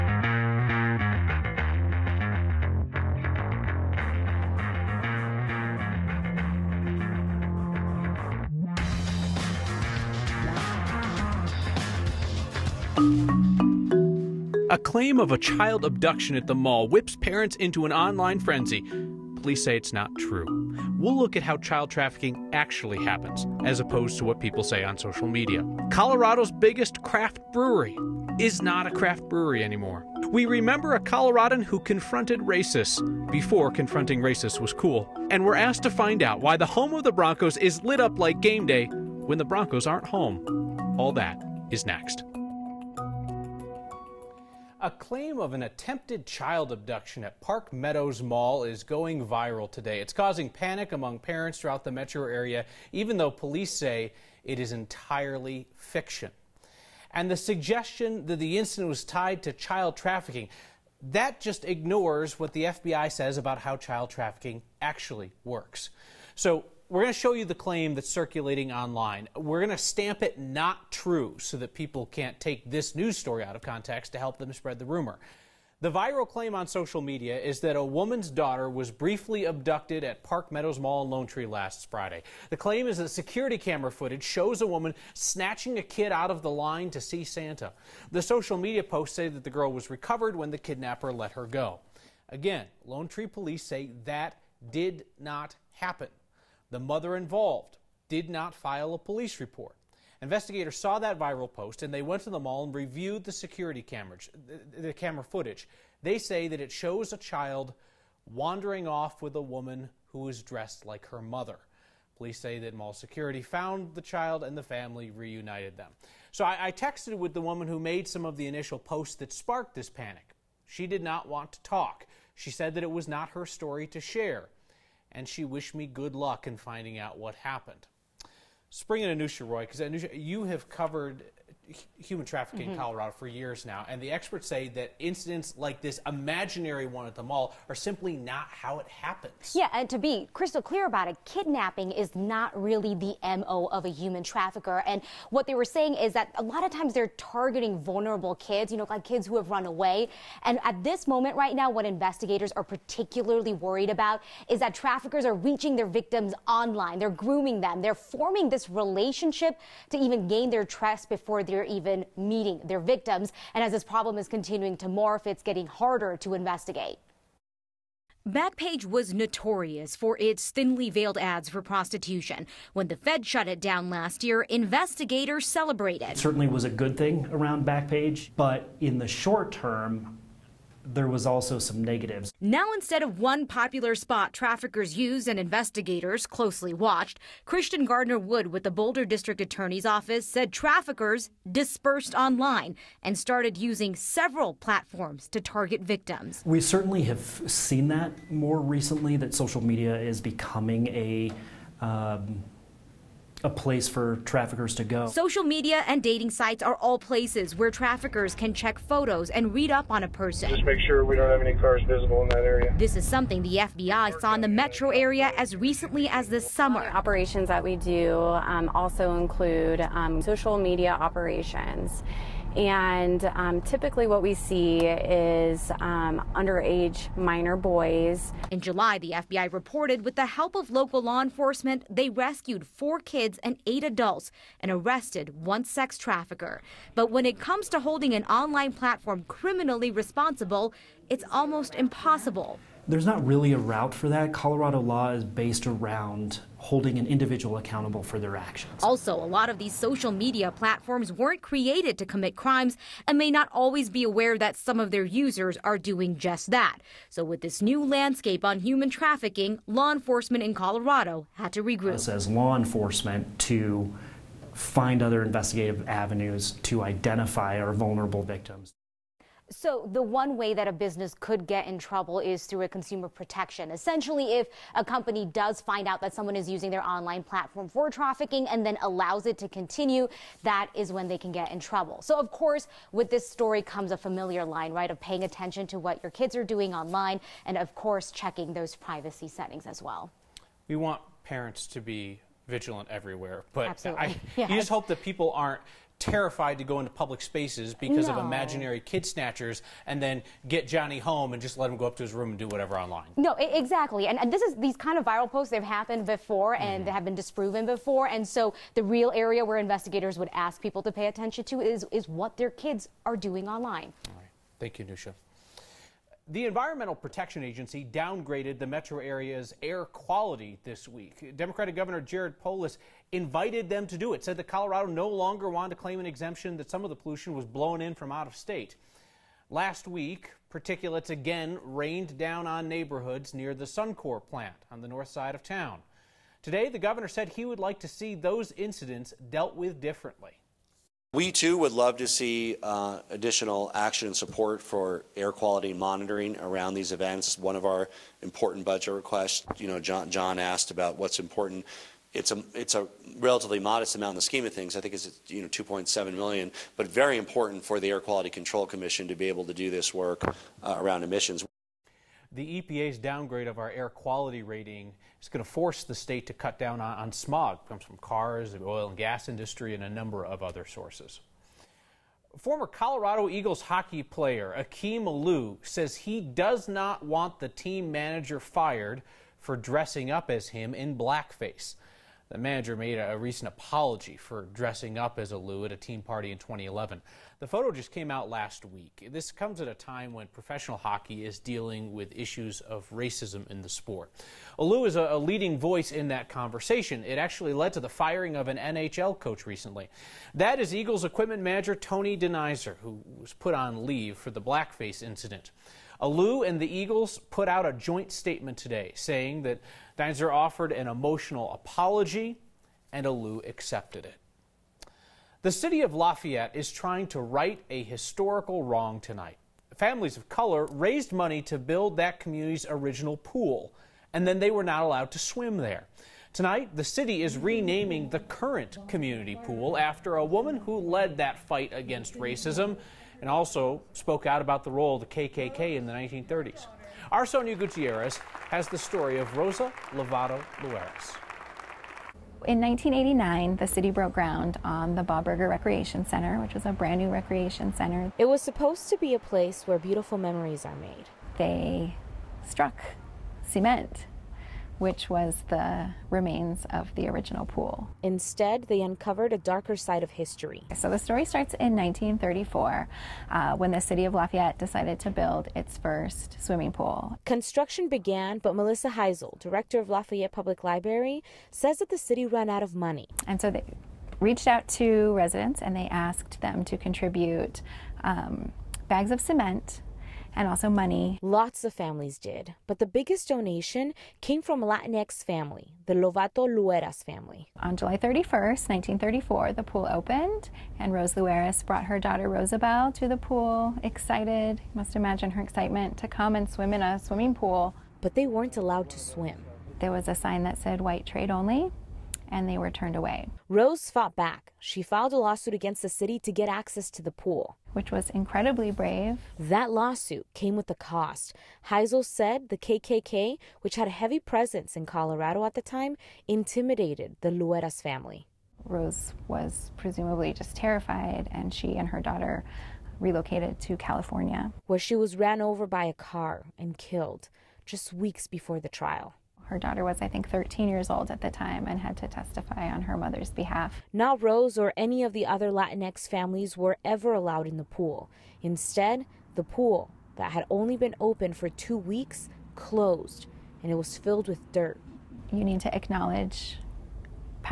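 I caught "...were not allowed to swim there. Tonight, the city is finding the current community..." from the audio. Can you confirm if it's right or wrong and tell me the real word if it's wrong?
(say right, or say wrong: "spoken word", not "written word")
wrong: "renaming", not "finding".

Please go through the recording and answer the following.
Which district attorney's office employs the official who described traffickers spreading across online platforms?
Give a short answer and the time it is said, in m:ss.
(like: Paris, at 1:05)
Boulder District Attorney's Office, at 3:08.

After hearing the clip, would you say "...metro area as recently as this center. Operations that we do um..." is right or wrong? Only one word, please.
wrong.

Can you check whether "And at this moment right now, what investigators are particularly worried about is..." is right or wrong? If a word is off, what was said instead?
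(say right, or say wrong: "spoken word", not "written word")
right.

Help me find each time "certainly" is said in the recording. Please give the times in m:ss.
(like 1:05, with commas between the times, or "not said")
2:56, 3:16.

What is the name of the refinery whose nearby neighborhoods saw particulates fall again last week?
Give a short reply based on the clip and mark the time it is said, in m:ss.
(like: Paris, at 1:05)
Suncor, at 5:33.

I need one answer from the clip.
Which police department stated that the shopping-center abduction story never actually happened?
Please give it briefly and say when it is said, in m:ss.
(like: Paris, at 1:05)
Lone Tree police, at 1:32.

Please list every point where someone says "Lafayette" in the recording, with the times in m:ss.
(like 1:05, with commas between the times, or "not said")
6:55, 7:44, 7:49.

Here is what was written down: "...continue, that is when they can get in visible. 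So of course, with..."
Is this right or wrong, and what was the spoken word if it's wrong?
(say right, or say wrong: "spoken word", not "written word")
wrong: "trouble", not "visible".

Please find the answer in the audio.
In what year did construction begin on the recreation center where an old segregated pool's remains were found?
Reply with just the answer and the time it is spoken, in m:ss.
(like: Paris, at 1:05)
1989, at 7:22.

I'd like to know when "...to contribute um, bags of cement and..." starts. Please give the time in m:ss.
7:56.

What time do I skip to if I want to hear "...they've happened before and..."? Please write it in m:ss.
5:05.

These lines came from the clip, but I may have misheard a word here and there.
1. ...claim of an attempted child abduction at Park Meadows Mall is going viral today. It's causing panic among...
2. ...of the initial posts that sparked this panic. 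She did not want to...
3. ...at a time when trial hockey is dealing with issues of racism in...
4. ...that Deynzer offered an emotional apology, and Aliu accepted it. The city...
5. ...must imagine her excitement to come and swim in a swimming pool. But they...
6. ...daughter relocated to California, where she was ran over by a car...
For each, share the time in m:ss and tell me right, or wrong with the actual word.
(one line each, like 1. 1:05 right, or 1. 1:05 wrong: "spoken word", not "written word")
1. 0:44 right
2. 1:58 right
3. 6:29 wrong: "professional", not "trial"
4. 6:49 right
5. 8:14 right
6. 8:41 right.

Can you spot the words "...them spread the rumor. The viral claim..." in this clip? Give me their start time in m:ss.
1:14.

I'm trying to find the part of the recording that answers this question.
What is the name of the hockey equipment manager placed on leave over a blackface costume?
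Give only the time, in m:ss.
6:41.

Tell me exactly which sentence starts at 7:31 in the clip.
They struck cement which was the remains of the original pool.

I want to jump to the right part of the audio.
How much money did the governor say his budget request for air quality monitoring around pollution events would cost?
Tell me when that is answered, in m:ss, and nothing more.
5:55.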